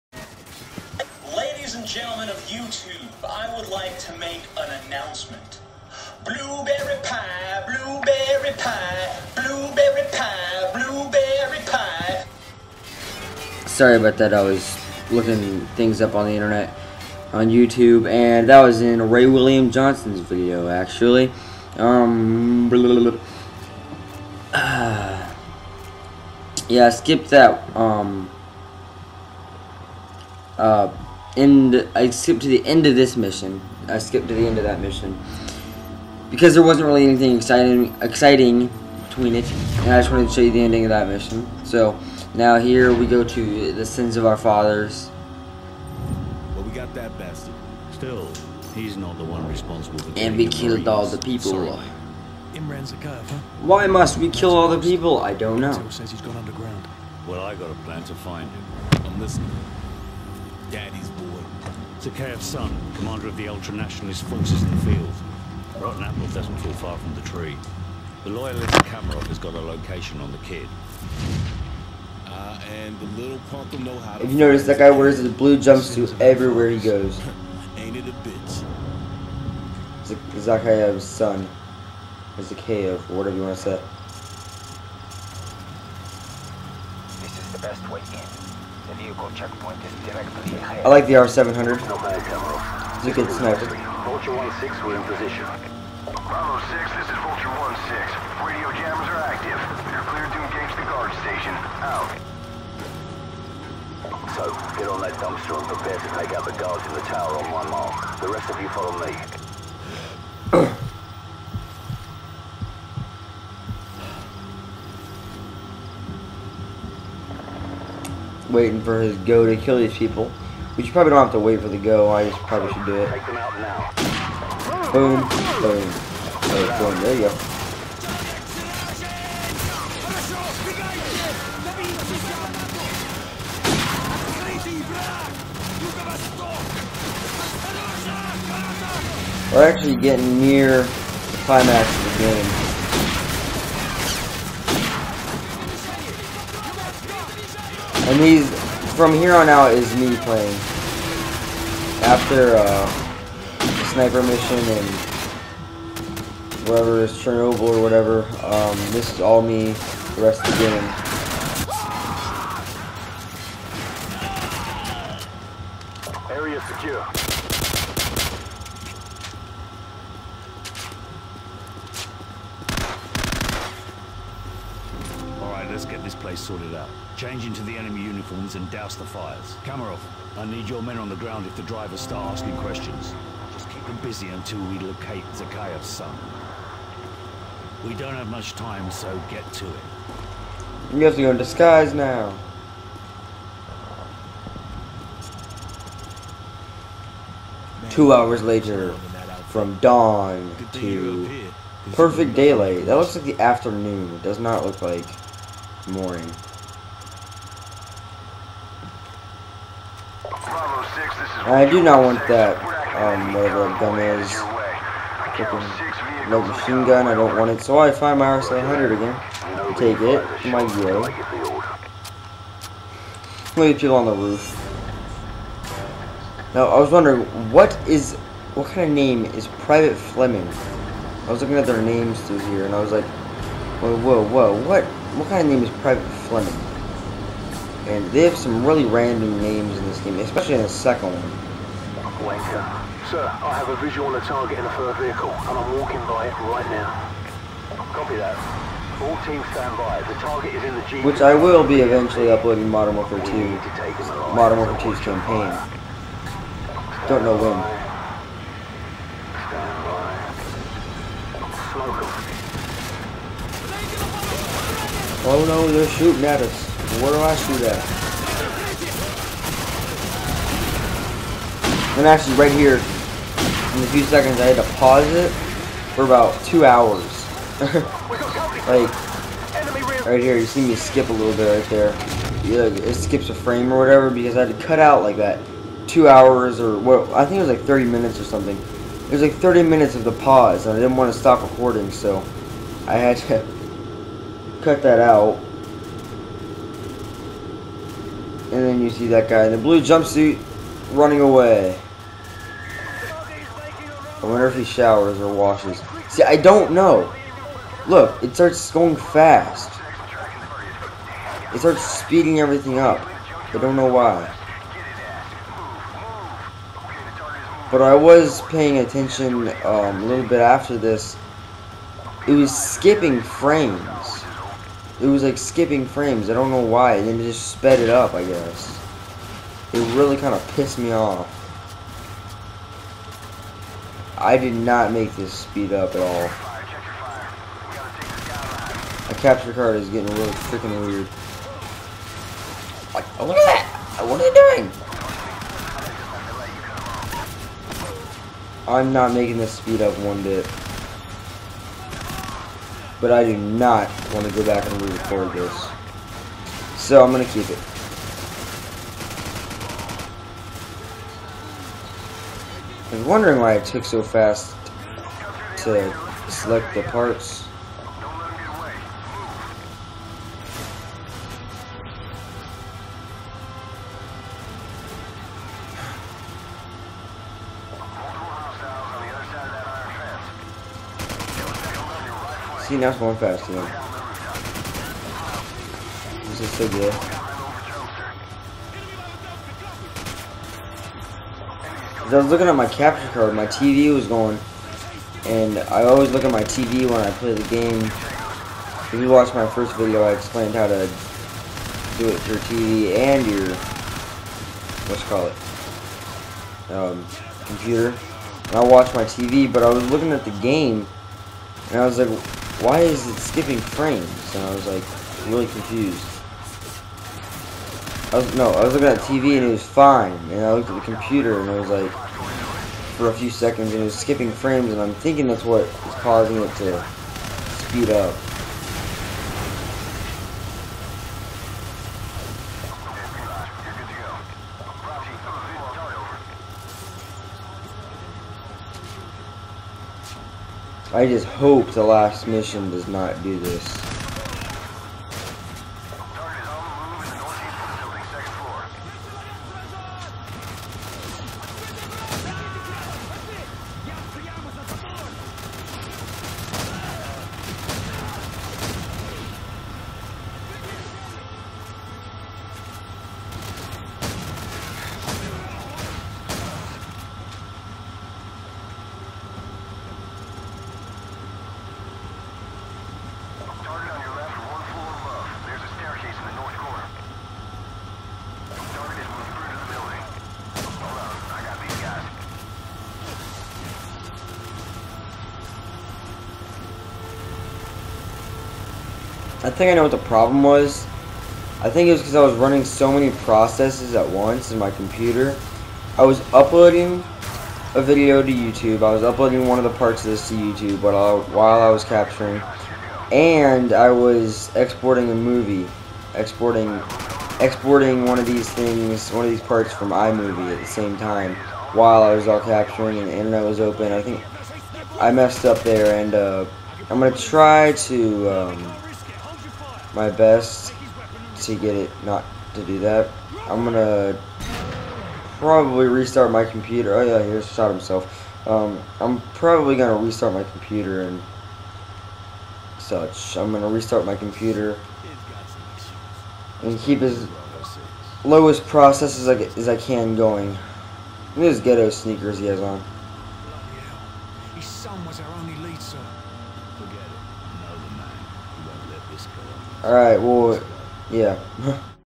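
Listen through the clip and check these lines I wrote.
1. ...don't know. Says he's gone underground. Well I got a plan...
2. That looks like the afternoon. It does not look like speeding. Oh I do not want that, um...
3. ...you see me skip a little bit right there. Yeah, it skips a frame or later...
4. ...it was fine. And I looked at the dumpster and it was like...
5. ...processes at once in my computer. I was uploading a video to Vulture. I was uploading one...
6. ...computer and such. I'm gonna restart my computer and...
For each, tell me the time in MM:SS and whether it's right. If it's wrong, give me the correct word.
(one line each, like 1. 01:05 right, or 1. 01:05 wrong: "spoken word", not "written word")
1. 00:55 right
2. 03:22 wrong: "mooring", not "speeding"
3. 04:40 wrong: "whatever", not "later"
4. 06:59 wrong: "computer", not "dumpster"
5. 08:13 wrong: "YouTube", not "Vulture"
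6. 08:50 right.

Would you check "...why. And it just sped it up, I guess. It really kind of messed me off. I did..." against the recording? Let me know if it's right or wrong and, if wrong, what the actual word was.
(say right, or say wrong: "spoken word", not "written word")
wrong: "pissed", not "messed".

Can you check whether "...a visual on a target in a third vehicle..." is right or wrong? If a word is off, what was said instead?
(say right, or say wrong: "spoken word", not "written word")
right.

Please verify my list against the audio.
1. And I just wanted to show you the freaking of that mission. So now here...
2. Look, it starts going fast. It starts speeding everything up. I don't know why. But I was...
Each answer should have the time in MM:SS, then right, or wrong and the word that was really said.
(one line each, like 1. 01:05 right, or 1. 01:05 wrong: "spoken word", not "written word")
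1. 00:39 wrong: "ending", not "freaking"
2. 05:07 right.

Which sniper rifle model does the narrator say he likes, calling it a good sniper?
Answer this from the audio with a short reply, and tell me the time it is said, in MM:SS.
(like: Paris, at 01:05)
R700, at 01:31.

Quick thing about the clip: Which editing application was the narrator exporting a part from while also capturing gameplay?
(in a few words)
iMovie.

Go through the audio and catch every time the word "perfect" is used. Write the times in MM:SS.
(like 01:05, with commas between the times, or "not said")
03:21.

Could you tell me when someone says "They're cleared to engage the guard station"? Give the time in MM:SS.
01:39.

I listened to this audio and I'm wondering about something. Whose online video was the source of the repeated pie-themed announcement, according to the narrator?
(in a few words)
Ray William Johnson.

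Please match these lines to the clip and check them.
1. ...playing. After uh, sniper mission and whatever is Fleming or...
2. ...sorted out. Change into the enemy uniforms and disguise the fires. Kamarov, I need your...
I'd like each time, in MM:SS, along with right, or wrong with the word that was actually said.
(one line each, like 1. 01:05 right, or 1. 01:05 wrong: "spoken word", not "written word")
1. 02:30 wrong: "Chernobyl", not "Fleming"
2. 02:56 wrong: "douse", not "disguise".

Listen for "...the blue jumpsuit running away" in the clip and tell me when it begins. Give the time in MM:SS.
04:59.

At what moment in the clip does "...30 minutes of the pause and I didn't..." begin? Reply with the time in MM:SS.
04:49.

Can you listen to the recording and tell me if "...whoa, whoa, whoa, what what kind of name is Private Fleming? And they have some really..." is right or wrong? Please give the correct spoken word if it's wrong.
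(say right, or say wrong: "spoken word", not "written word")
right.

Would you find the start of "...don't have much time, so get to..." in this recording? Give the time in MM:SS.
03:07.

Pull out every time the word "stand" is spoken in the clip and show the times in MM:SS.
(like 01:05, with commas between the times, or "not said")
04:09, 04:21.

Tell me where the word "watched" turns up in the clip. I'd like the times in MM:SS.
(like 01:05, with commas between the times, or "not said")
06:39, 06:48.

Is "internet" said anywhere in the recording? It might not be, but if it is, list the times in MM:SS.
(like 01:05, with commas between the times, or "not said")
00:16, 08:33.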